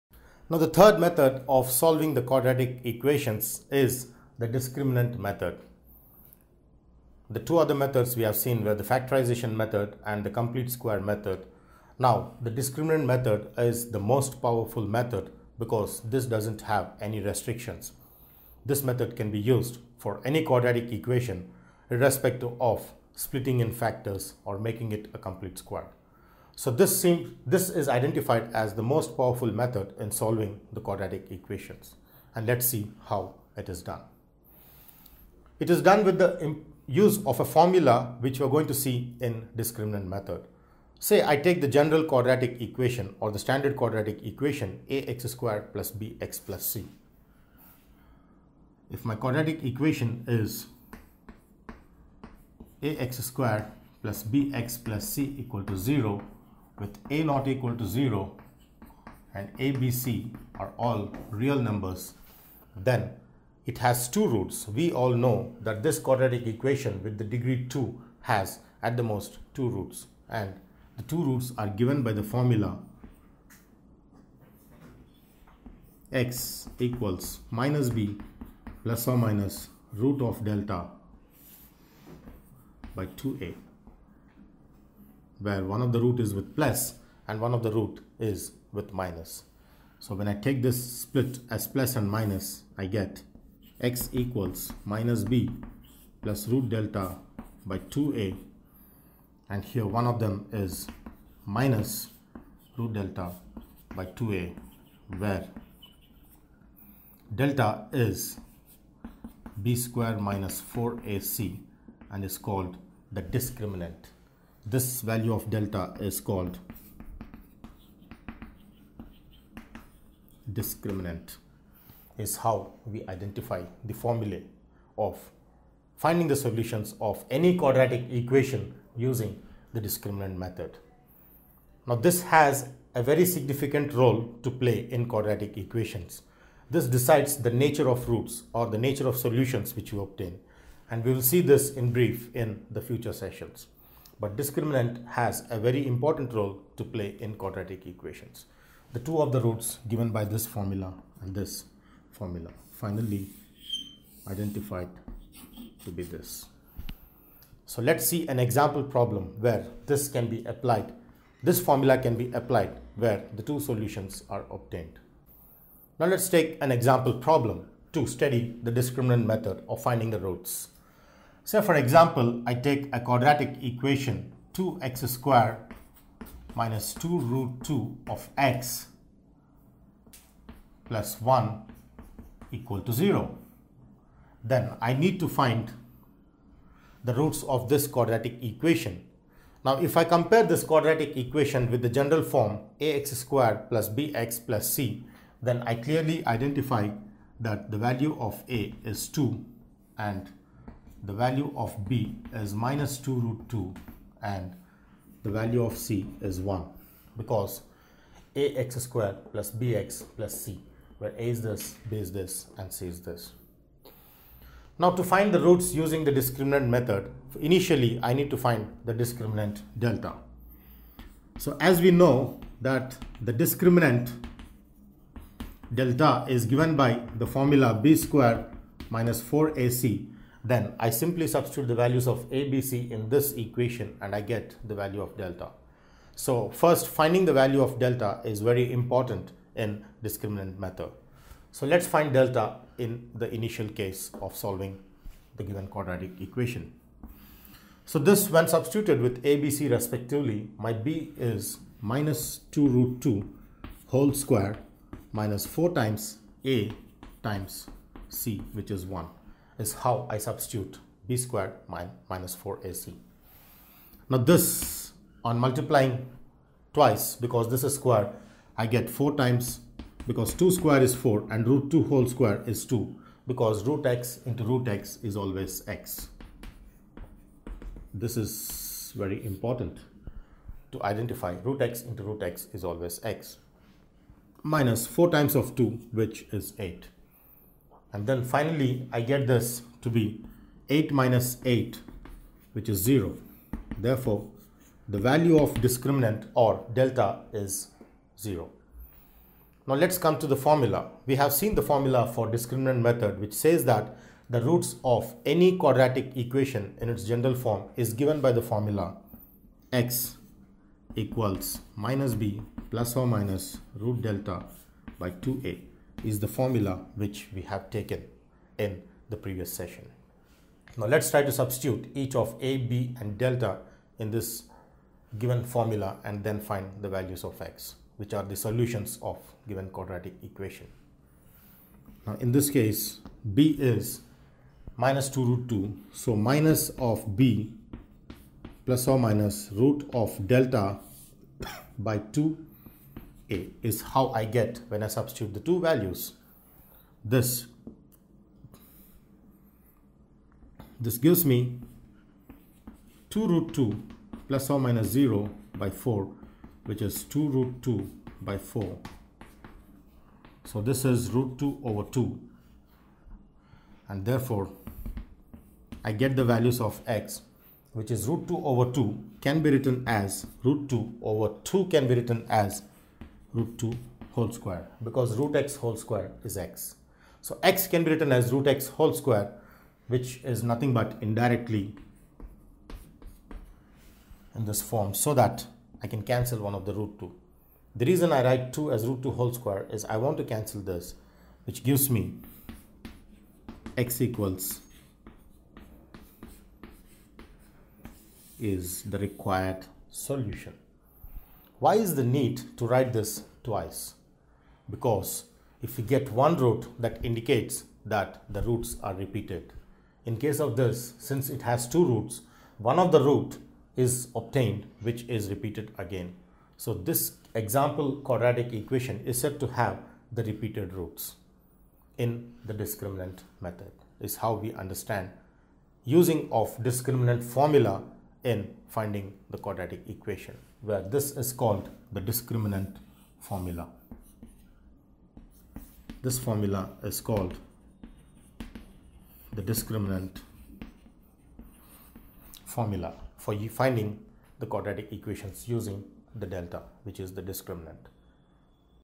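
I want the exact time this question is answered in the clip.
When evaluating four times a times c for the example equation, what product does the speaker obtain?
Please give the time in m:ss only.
4:46.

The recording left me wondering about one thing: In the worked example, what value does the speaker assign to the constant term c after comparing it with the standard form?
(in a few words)
1.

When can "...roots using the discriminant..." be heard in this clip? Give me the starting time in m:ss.
3:35.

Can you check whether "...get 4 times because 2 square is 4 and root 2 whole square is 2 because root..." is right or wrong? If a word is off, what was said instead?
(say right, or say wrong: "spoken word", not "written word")
right.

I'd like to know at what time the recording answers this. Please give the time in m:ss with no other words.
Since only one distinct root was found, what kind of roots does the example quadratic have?
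7:00.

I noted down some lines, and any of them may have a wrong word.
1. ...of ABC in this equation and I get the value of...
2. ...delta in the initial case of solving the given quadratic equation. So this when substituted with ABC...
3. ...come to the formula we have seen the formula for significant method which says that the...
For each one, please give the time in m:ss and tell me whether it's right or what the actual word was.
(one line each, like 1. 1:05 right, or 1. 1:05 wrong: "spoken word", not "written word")
1. 3:52 right
2. 4:02 right
3. 4:59 wrong: "discriminant", not "significant".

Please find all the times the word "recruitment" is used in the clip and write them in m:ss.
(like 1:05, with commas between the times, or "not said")
not said.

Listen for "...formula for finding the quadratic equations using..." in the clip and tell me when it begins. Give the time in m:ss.
7:22.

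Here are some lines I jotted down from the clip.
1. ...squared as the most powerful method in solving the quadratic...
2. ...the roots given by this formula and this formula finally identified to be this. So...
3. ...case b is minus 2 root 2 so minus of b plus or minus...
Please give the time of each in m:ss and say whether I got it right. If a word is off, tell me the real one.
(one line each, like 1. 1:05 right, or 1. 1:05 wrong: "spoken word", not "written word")
1. 0:27 wrong: "identified", not "squared"
2. 2:29 right
3. 5:32 right.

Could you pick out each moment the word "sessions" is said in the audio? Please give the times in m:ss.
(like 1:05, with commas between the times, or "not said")
2:23, 5:19.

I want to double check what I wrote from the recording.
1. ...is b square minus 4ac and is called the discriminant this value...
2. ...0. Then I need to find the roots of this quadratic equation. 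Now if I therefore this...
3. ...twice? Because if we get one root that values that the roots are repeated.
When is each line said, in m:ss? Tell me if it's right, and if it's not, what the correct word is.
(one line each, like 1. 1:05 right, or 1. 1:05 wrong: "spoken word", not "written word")
1. 1:47 right
2. 3:02 wrong: "compare", not "therefore"
3. 6:43 wrong: "indicates", not "values".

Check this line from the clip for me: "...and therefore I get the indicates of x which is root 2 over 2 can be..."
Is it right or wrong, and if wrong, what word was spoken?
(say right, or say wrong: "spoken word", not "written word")
wrong: "values", not "indicates".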